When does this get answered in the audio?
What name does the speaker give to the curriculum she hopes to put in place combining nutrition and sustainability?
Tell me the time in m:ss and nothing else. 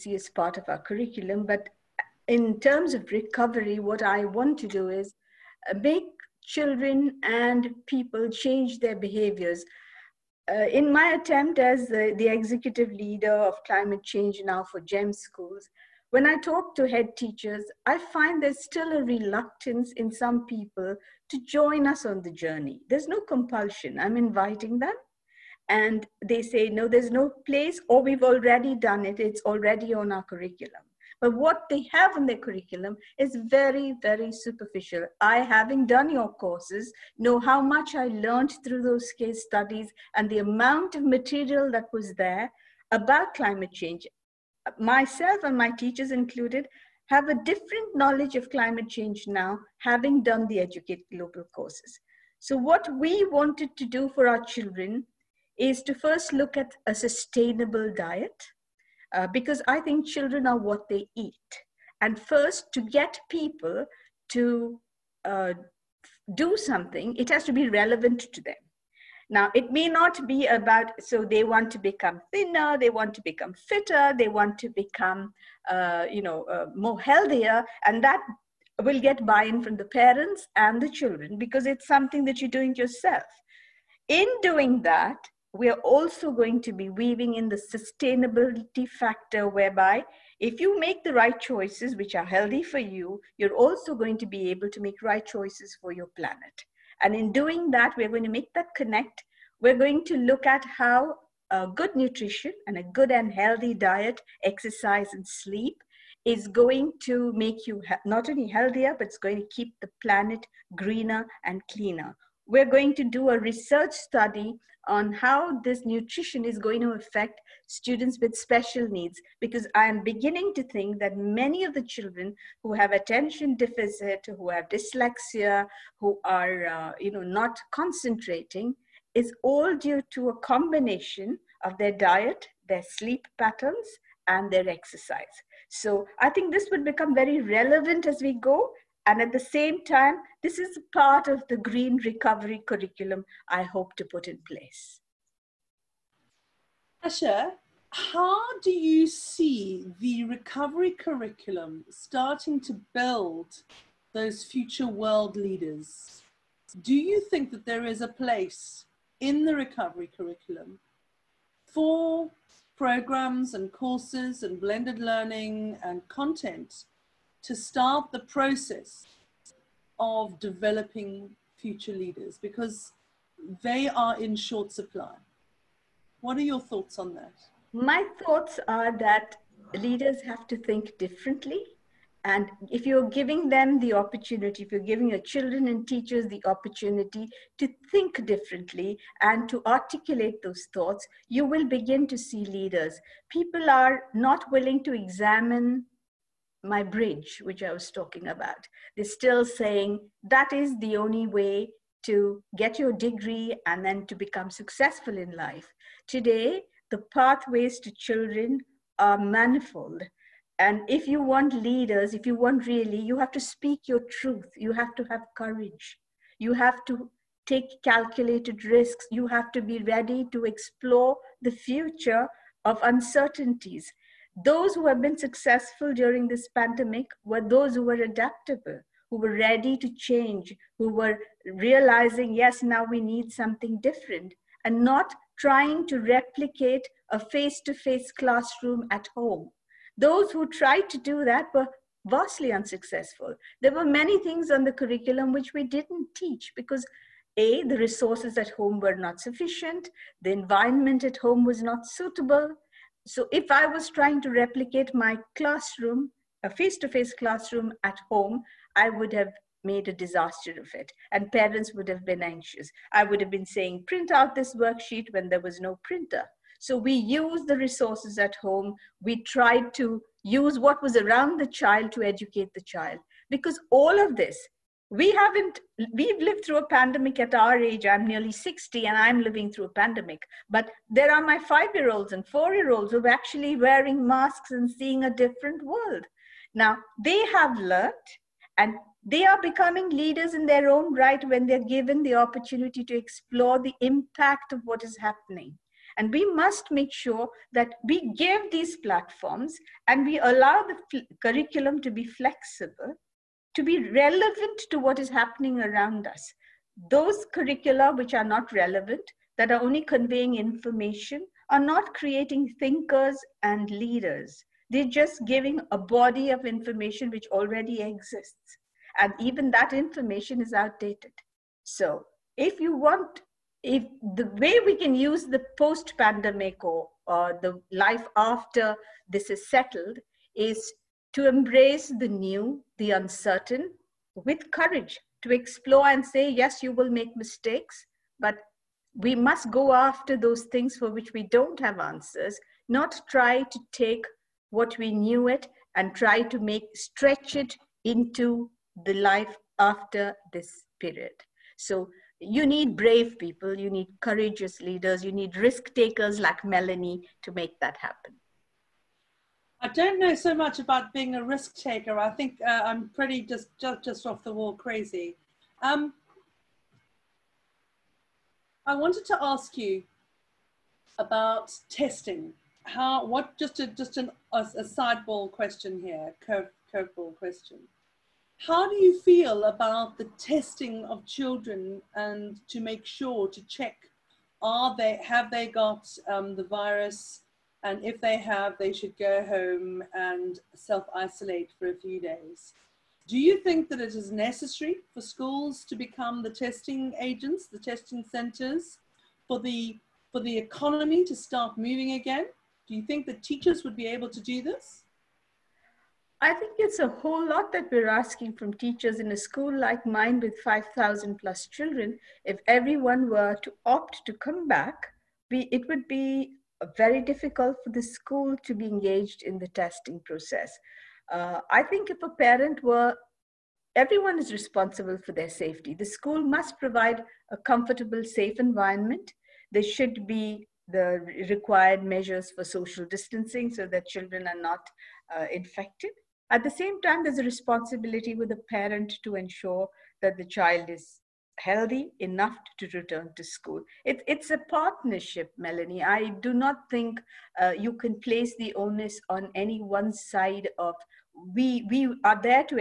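2:21.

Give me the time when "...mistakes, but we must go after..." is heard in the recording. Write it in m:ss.
5:37.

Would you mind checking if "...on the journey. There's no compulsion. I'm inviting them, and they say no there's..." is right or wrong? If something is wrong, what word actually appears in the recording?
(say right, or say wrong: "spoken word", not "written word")
right.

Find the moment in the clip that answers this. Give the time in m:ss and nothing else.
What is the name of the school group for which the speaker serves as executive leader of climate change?
0:14.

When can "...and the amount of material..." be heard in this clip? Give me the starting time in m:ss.
0:40.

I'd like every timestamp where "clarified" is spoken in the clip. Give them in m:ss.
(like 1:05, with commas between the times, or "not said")
not said.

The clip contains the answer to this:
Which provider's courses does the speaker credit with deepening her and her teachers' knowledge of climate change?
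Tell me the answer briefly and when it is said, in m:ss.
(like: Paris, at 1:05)
Educate Global, at 0:50.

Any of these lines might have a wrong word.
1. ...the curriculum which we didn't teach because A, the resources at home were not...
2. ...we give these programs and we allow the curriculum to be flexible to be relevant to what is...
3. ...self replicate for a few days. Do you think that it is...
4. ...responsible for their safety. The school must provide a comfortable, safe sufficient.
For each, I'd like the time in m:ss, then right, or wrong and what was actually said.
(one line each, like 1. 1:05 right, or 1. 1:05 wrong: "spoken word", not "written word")
1. 4:04 right
2. 4:57 wrong: "platforms", not "programs"
3. 6:30 wrong: "isolate", not "replicate"
4. 7:04 wrong: "environment", not "sufficient".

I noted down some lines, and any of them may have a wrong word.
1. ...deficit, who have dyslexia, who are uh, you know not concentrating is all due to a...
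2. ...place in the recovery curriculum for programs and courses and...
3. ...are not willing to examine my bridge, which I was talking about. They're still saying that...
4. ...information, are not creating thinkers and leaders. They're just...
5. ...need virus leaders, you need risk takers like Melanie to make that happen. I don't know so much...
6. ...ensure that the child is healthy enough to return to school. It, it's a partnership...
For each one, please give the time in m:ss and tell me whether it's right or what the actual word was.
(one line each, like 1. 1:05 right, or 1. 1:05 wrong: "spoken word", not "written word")
1. 2:03 right
2. 2:38 right
3. 3:13 right
4. 5:10 right
5. 5:53 wrong: "courageous", not "virus"
6. 7:19 right.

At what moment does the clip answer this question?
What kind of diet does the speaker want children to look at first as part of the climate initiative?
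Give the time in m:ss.
0:56.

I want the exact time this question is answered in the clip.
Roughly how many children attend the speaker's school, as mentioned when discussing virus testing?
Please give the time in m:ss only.
6:50.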